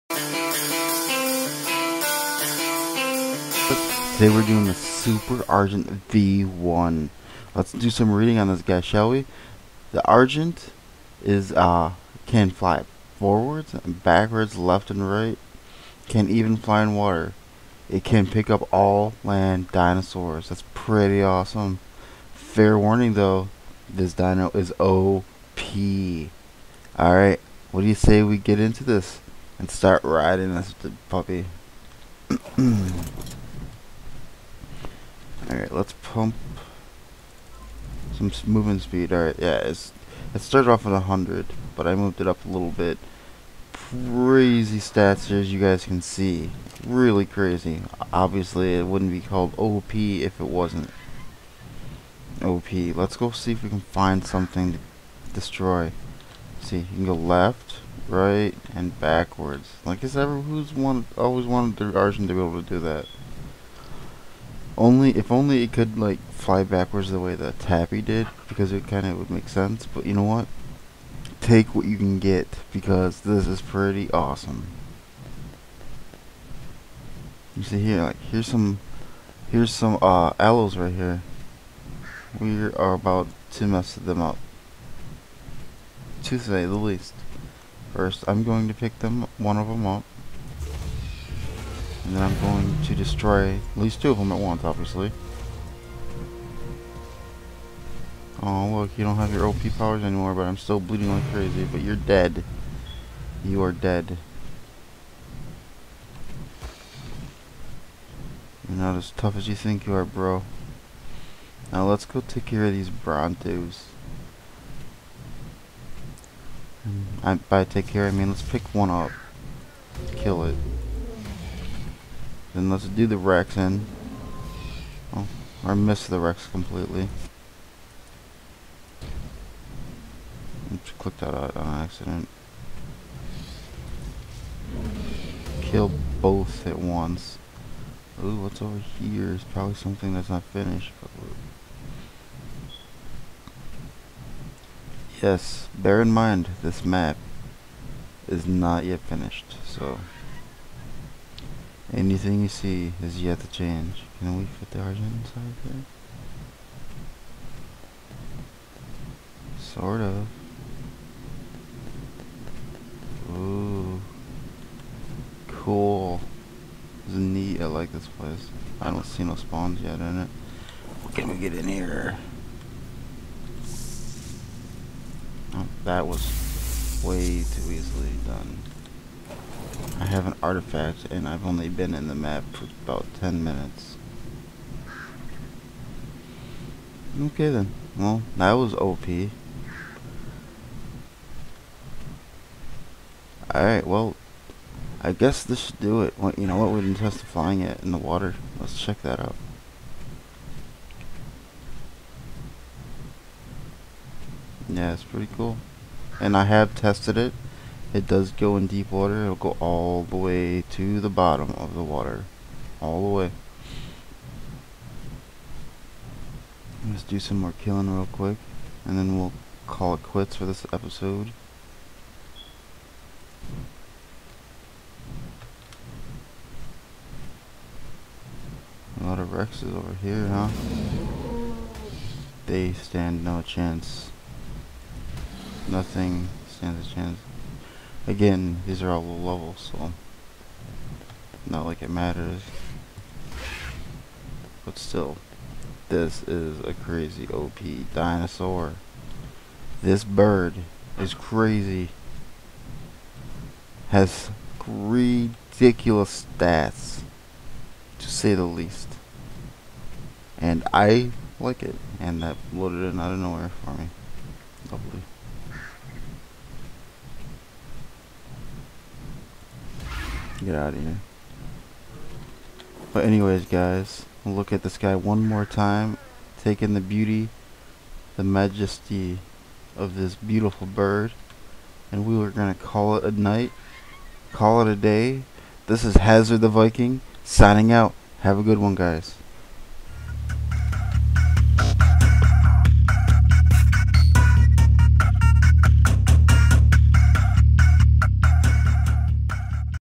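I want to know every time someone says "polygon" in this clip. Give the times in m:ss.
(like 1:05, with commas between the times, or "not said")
not said.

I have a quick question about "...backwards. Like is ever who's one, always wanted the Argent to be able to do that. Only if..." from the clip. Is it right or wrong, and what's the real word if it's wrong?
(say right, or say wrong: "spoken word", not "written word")
right.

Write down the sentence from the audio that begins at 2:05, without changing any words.
Oh, I missed the Rex completely.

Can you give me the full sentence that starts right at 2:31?
Anything you see is yet to change.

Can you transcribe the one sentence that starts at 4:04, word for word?
But still, this is a crazy OP dinosaur.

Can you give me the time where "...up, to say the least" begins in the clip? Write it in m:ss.
1:24.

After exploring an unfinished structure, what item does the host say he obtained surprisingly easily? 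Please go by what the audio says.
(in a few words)
an artifact.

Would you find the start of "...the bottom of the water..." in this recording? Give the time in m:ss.
3:31.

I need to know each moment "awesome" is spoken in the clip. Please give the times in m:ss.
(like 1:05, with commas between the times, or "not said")
0:21, 1:14.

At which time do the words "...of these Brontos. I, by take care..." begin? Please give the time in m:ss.
1:52.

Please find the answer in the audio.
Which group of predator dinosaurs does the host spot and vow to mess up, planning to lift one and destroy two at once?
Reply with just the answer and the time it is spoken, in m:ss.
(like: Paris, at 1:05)
Allos, at 1:20.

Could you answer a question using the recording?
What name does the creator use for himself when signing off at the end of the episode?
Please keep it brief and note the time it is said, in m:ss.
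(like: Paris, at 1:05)
Hazard the Viking, at 4:45.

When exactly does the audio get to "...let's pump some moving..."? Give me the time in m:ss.
0:35.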